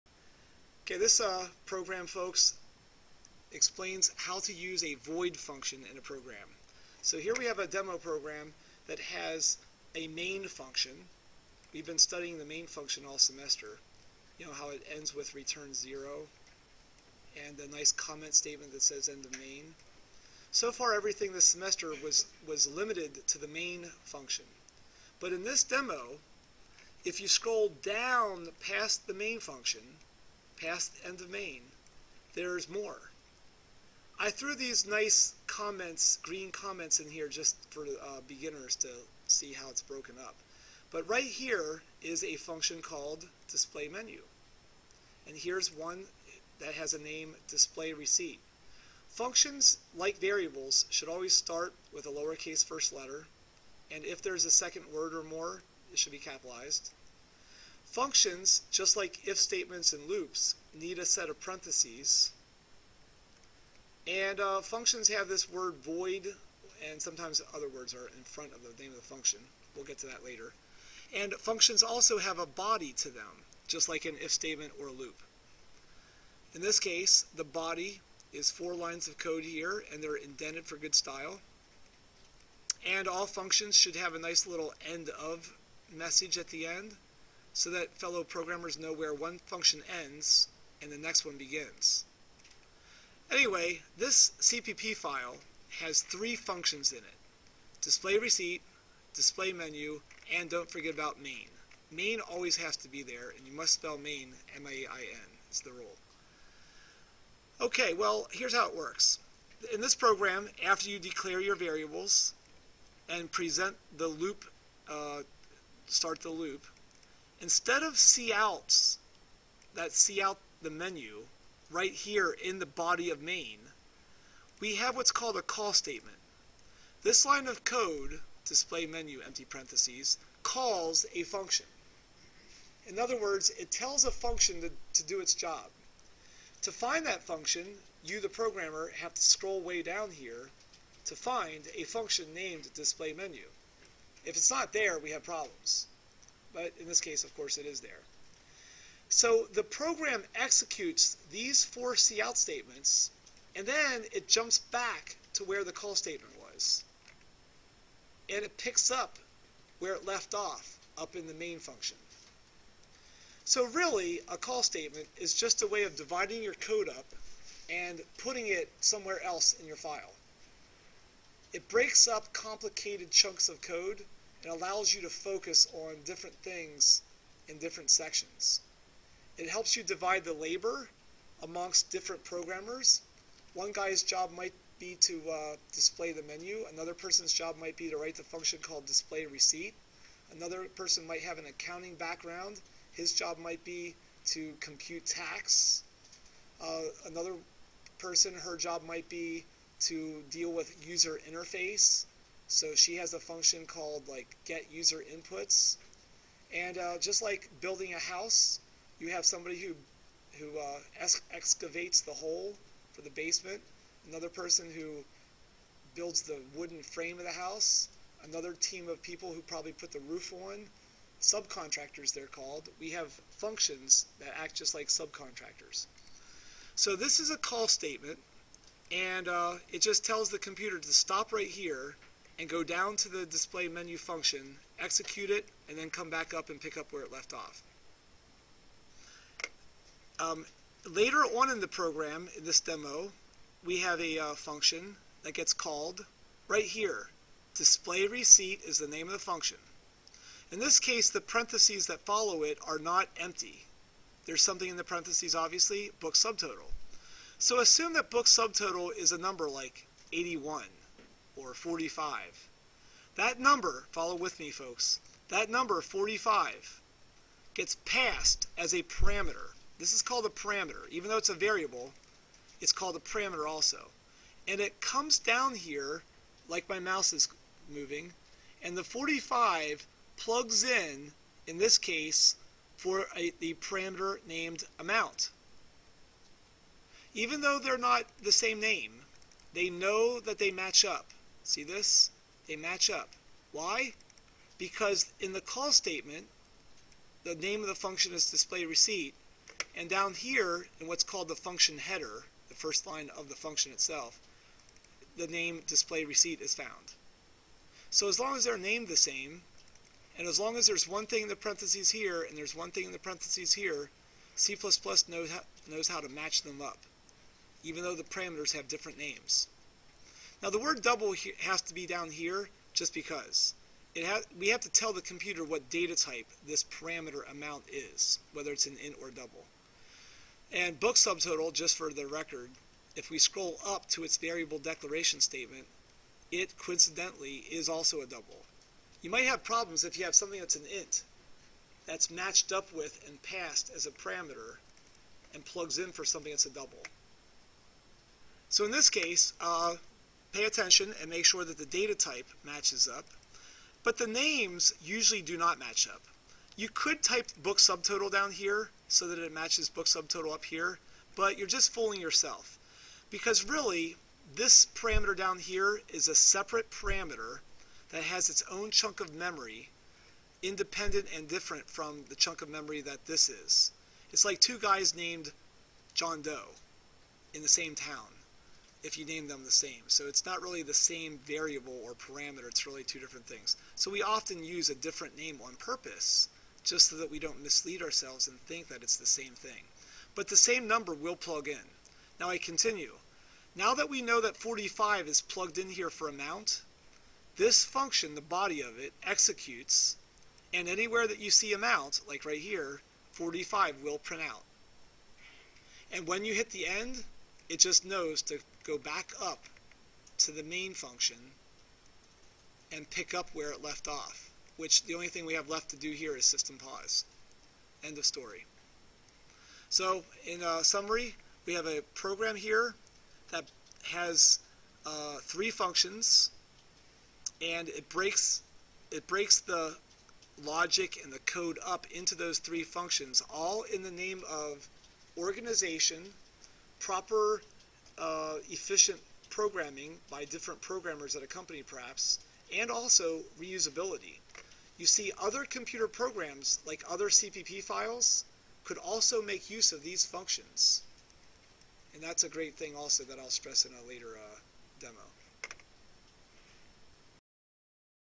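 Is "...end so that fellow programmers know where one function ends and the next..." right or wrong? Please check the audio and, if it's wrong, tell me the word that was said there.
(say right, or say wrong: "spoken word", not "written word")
right.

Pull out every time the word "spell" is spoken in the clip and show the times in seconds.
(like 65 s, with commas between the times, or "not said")
103 s.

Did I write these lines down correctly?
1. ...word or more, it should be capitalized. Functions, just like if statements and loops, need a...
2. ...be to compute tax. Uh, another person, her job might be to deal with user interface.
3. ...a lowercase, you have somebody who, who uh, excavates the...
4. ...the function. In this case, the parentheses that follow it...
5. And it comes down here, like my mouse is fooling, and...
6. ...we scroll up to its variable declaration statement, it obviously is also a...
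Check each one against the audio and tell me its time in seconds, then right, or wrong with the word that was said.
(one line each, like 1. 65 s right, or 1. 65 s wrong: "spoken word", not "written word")
1. 54 s right
2. 193 s right
3. 207 s wrong: "house", not "lowercase"
4. 249 s right
5. 274 s wrong: "moving", not "fooling"
6. 333 s wrong: "coincidentally", not "obviously".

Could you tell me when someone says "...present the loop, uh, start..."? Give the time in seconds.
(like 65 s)
113 s.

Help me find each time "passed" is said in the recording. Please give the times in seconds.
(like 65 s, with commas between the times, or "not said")
267 s, 343 s.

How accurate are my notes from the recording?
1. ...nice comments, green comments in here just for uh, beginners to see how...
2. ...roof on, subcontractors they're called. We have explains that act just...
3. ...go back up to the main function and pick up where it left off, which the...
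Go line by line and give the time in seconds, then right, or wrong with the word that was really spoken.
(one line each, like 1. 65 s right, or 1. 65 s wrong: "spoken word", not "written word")
1. 34 s right
2. 220 s wrong: "functions", not "explains"
3. 408 s right.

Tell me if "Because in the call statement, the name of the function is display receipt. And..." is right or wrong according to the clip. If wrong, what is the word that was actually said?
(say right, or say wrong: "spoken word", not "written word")
right.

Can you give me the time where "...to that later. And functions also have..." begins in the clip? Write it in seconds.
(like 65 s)
69 s.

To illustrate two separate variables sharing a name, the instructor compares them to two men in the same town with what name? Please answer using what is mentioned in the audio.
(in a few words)
John Doe.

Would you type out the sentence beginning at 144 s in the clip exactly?
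If it's not there, we have problems but in this case, of course, it is there.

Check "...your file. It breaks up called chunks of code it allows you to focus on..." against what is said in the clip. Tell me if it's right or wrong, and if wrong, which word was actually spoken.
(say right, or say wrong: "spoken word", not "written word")
wrong: "complicated", not "called".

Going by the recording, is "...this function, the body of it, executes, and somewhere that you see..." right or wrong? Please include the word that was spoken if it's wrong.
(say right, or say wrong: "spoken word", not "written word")
wrong: "anywhere", not "somewhere".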